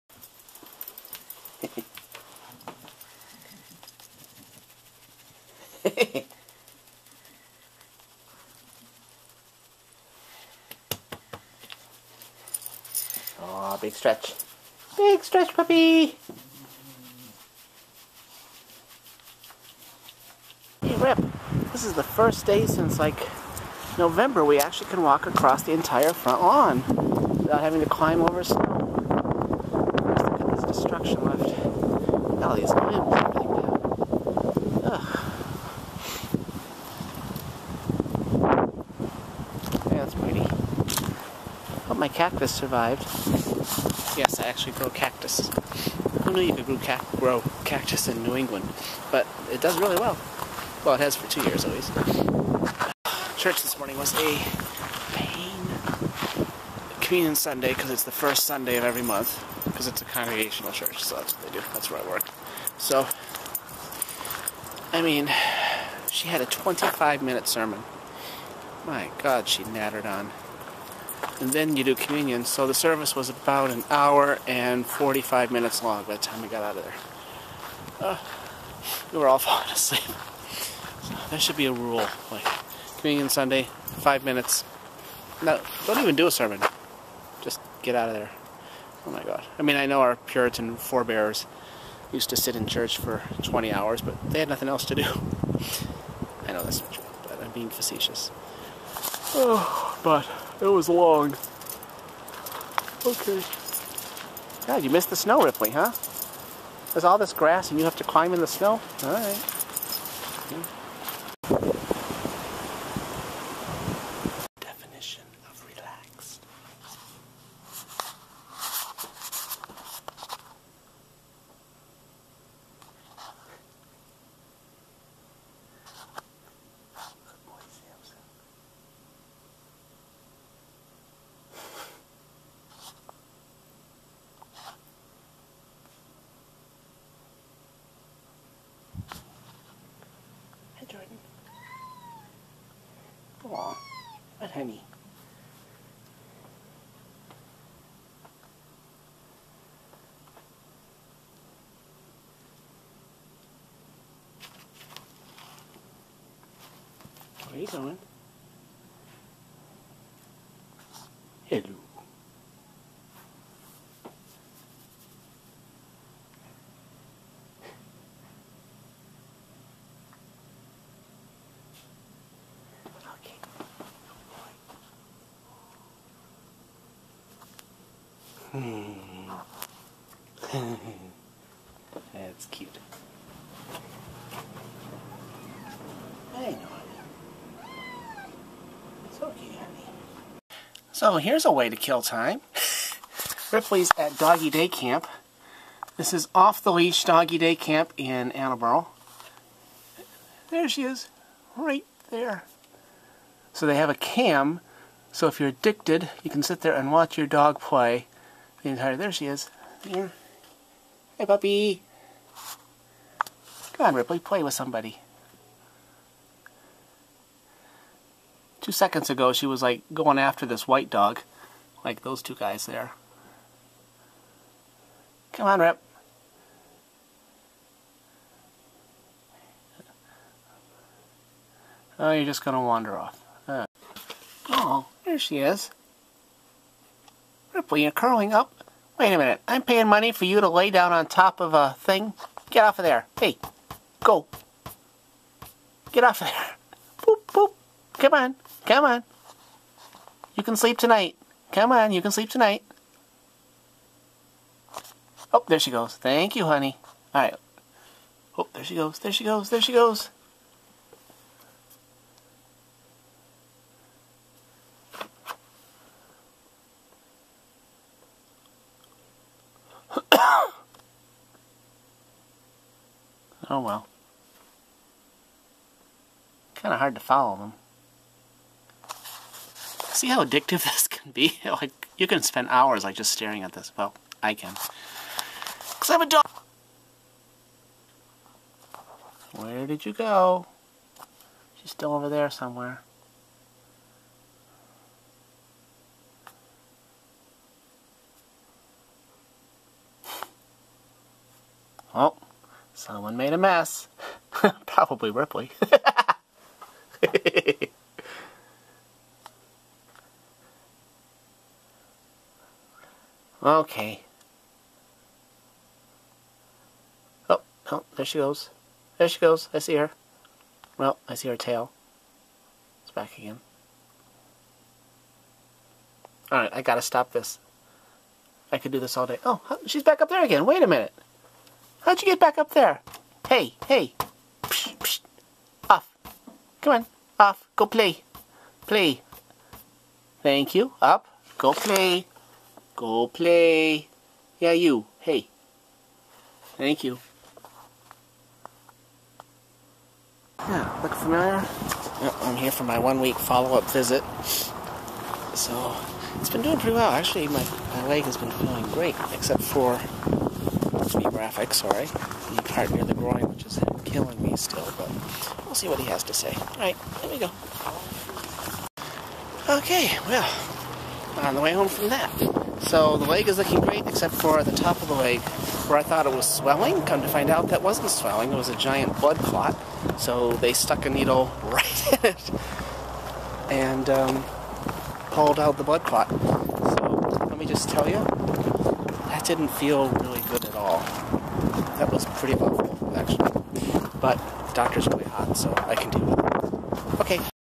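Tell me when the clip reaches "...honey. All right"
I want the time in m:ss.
4:16.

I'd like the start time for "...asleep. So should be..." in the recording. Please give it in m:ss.
1:19.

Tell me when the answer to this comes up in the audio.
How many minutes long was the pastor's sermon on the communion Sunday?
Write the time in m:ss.
1:06.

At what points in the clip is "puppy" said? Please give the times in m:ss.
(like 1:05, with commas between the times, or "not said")
0:15, 3:31.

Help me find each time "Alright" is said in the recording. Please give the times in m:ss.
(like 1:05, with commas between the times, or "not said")
5:26, 6:06.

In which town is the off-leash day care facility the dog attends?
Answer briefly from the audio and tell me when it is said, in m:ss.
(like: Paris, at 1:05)
Attleboro, at 3:18.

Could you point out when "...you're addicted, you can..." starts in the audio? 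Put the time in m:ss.
3:25.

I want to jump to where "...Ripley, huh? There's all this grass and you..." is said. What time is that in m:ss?
1:45.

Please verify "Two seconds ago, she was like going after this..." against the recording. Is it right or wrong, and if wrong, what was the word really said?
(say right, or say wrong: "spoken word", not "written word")
right.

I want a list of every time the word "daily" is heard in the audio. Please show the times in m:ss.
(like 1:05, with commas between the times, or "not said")
not said.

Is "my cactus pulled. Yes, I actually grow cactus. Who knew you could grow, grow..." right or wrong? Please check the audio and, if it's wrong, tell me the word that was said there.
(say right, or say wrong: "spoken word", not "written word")
wrong: "survived", not "pulled".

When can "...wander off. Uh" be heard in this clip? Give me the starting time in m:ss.
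3:52.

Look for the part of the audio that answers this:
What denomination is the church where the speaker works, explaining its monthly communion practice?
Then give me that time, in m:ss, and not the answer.
1:00.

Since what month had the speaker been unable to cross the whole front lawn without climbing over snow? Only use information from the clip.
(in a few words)
November.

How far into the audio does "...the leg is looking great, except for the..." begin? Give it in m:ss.
6:12.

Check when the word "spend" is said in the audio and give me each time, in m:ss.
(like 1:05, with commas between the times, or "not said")
4:42.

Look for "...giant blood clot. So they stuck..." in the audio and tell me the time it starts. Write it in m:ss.
6:18.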